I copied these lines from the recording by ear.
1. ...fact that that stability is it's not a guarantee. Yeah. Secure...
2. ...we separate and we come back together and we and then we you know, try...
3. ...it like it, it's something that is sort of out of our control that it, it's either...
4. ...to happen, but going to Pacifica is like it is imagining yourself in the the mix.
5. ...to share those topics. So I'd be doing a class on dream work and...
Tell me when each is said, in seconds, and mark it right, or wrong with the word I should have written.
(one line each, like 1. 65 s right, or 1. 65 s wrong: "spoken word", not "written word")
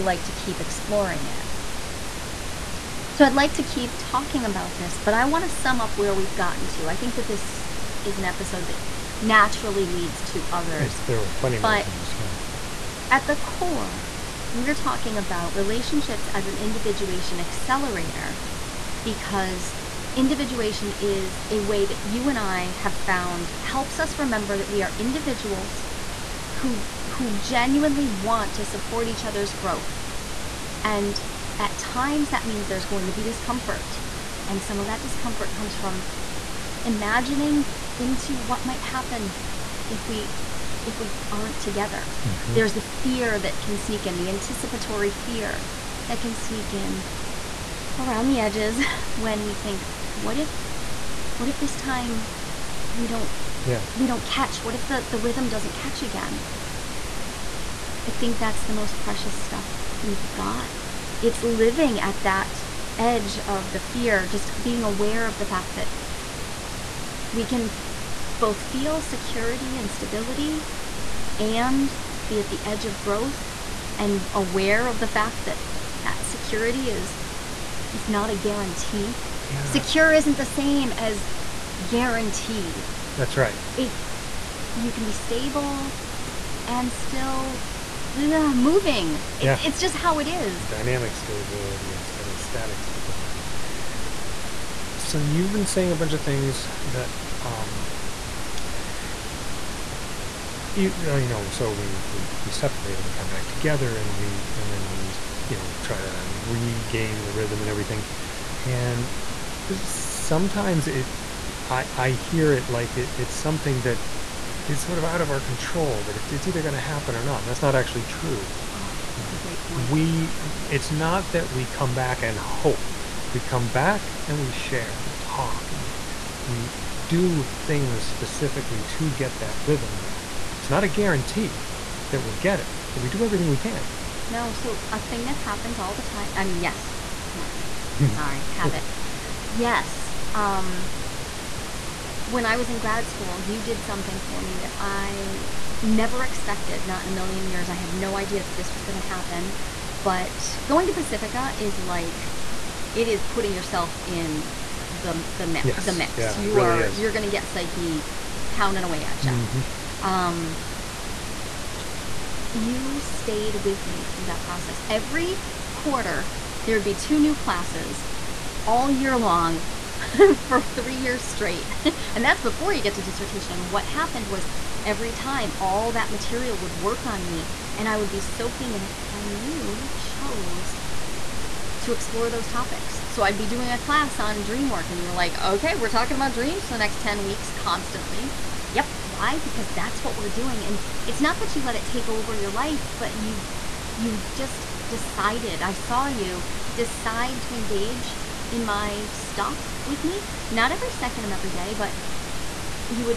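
1. 75 s wrong: "security", not "stability"
2. 102 s right
3. 112 s right
4. 148 s wrong: "putting", not "imagining"
5. 181 s wrong: "explore", not "share".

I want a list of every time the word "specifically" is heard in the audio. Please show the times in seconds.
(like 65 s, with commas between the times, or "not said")
128 s.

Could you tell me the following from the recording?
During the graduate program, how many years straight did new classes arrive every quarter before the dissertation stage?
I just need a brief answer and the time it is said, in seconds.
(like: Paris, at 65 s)
3, at 170 s.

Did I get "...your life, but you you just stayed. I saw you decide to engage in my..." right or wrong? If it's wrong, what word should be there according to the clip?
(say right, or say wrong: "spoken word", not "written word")
wrong: "decided", not "stayed".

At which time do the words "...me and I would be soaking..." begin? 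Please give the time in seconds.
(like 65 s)
177 s.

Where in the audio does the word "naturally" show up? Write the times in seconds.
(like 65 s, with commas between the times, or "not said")
9 s.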